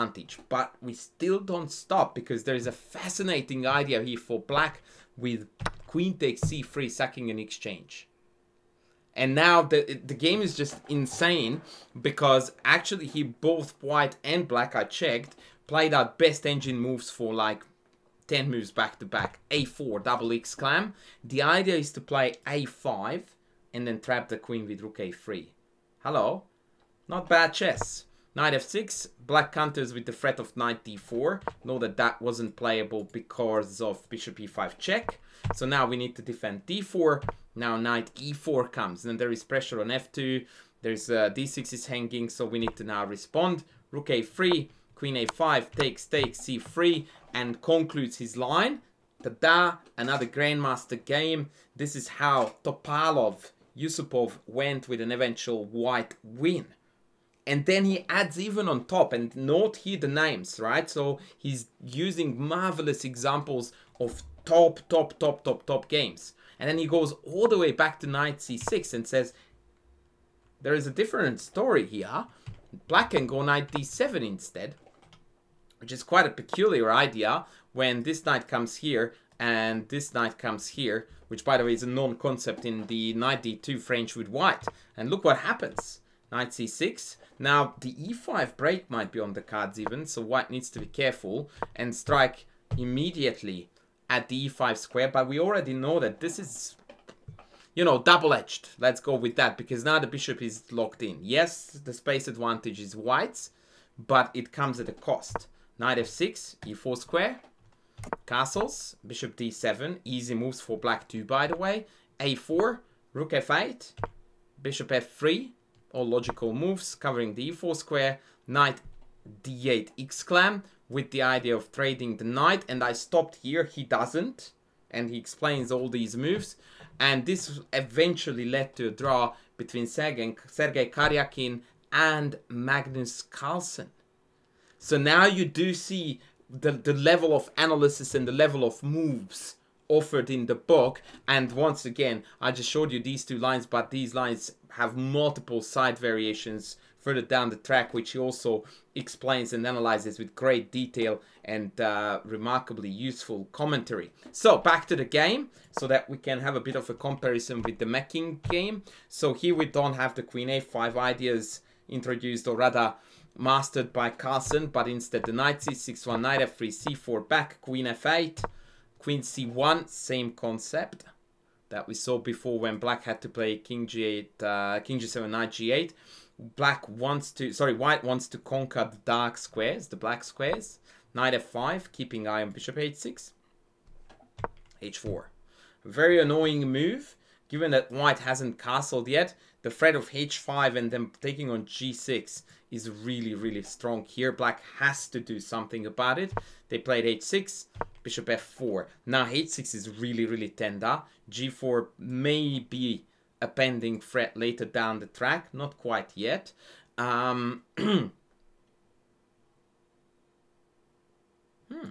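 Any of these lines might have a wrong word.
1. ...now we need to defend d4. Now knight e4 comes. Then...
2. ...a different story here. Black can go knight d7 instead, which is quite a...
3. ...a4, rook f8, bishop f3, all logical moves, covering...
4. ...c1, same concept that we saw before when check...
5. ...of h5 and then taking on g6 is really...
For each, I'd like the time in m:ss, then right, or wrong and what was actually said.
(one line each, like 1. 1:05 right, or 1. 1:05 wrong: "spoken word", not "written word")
1. 0:35 right
2. 1:10 right
3. 1:52 right
4. 2:49 wrong: "black", not "check"
5. 3:09 right.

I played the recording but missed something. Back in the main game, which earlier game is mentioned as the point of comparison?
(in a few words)
the Mecking game.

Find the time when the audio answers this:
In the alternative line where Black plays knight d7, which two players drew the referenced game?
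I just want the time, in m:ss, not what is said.
2:10.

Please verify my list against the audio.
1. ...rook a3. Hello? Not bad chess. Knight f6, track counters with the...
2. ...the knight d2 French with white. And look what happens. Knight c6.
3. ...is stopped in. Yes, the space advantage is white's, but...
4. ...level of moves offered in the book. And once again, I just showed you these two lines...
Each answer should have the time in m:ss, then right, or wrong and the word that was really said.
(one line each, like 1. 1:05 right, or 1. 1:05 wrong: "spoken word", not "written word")
1. 0:24 wrong: "black", not "track"
2. 1:22 right
3. 1:40 wrong: "locked", not "stopped"
4. 2:18 right.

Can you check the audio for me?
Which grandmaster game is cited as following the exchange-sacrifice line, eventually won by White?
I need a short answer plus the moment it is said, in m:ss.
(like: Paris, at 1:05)
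Topalov Yusupov, at 0:52.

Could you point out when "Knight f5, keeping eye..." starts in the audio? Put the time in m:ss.
3:01.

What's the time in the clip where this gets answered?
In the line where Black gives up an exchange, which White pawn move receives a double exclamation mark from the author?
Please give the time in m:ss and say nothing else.
0:19.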